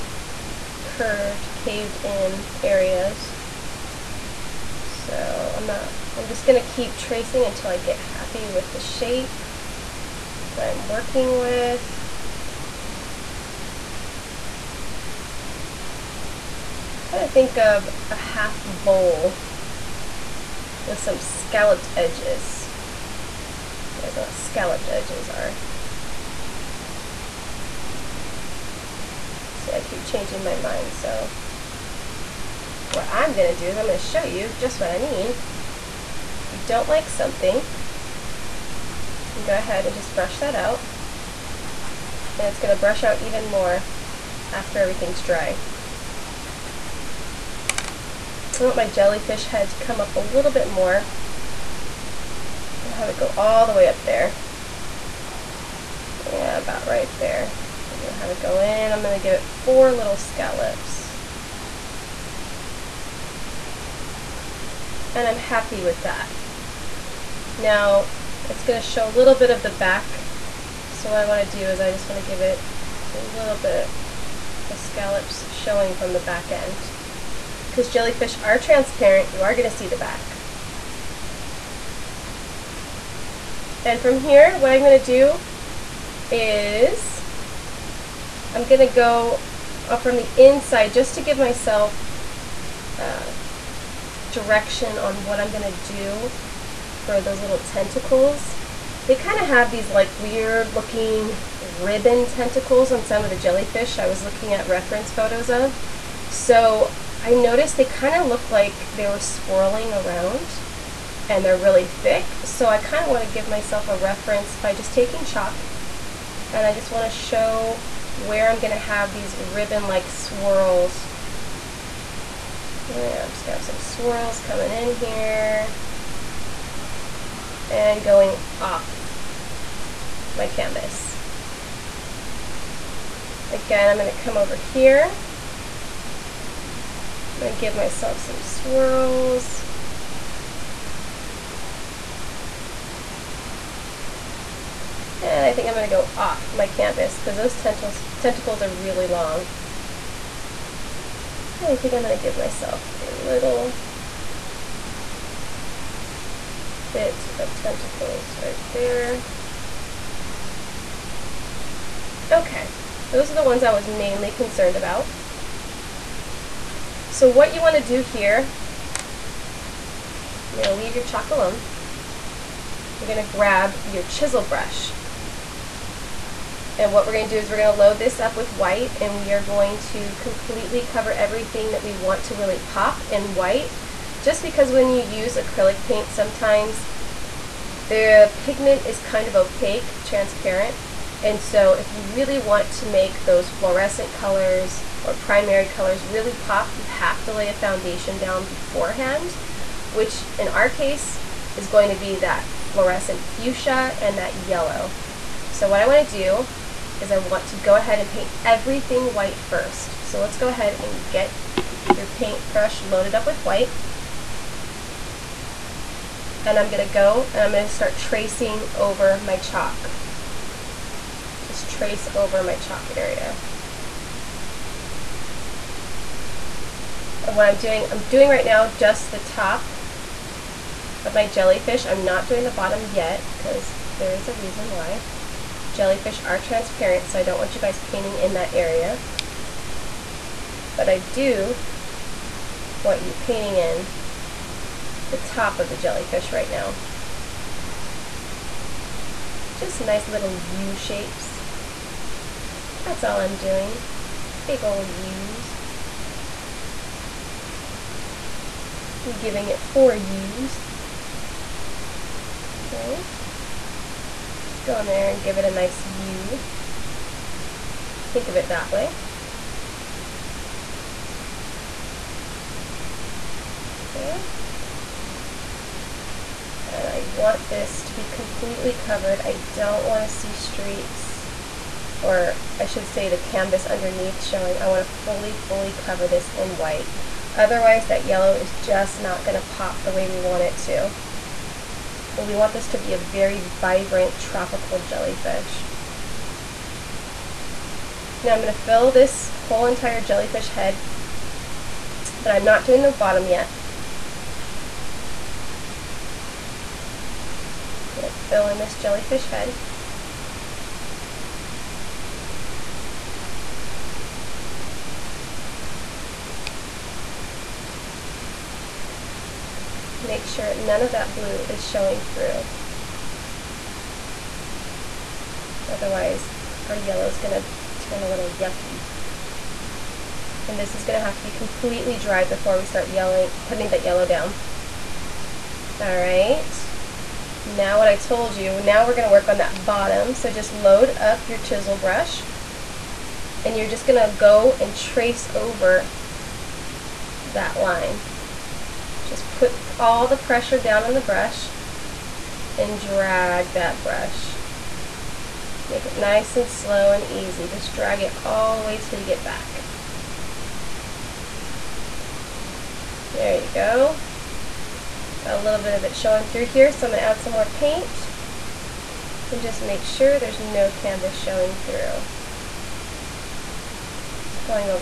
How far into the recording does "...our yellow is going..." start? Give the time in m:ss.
5:26.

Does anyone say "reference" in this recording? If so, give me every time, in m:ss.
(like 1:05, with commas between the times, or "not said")
1:44, 1:53.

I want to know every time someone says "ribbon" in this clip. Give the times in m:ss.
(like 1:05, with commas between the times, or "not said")
1:41, 1:59.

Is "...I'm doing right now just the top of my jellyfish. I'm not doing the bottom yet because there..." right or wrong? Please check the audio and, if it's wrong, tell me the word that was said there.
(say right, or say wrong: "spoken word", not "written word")
right.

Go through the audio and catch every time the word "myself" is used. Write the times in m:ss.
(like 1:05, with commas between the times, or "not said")
1:31, 1:53, 2:17, 2:32.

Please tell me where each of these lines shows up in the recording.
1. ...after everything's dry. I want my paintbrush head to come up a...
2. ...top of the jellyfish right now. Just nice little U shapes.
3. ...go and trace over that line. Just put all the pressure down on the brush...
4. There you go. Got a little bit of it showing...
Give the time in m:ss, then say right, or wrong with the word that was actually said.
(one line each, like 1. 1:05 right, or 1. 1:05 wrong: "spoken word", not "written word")
1. 0:44 wrong: "jellyfish", not "paintbrush"
2. 4:05 right
3. 5:44 right
4. 6:03 right.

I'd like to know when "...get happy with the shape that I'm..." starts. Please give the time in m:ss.
0:07.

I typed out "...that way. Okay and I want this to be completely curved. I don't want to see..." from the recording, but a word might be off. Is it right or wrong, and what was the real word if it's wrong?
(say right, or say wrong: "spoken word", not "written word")
wrong: "covered", not "curved".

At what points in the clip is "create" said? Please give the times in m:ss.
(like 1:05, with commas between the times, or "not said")
not said.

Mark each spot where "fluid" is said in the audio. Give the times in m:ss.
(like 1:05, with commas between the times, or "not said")
not said.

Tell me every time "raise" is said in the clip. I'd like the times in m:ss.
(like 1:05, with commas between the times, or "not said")
not said.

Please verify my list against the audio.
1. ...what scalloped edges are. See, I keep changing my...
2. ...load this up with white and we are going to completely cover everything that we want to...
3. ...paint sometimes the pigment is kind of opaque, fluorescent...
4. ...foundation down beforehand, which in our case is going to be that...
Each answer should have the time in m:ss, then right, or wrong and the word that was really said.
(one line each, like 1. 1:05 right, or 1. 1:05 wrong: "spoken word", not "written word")
1. 0:24 right
2. 2:57 right
3. 3:05 wrong: "transparent", not "fluorescent"
4. 3:17 right.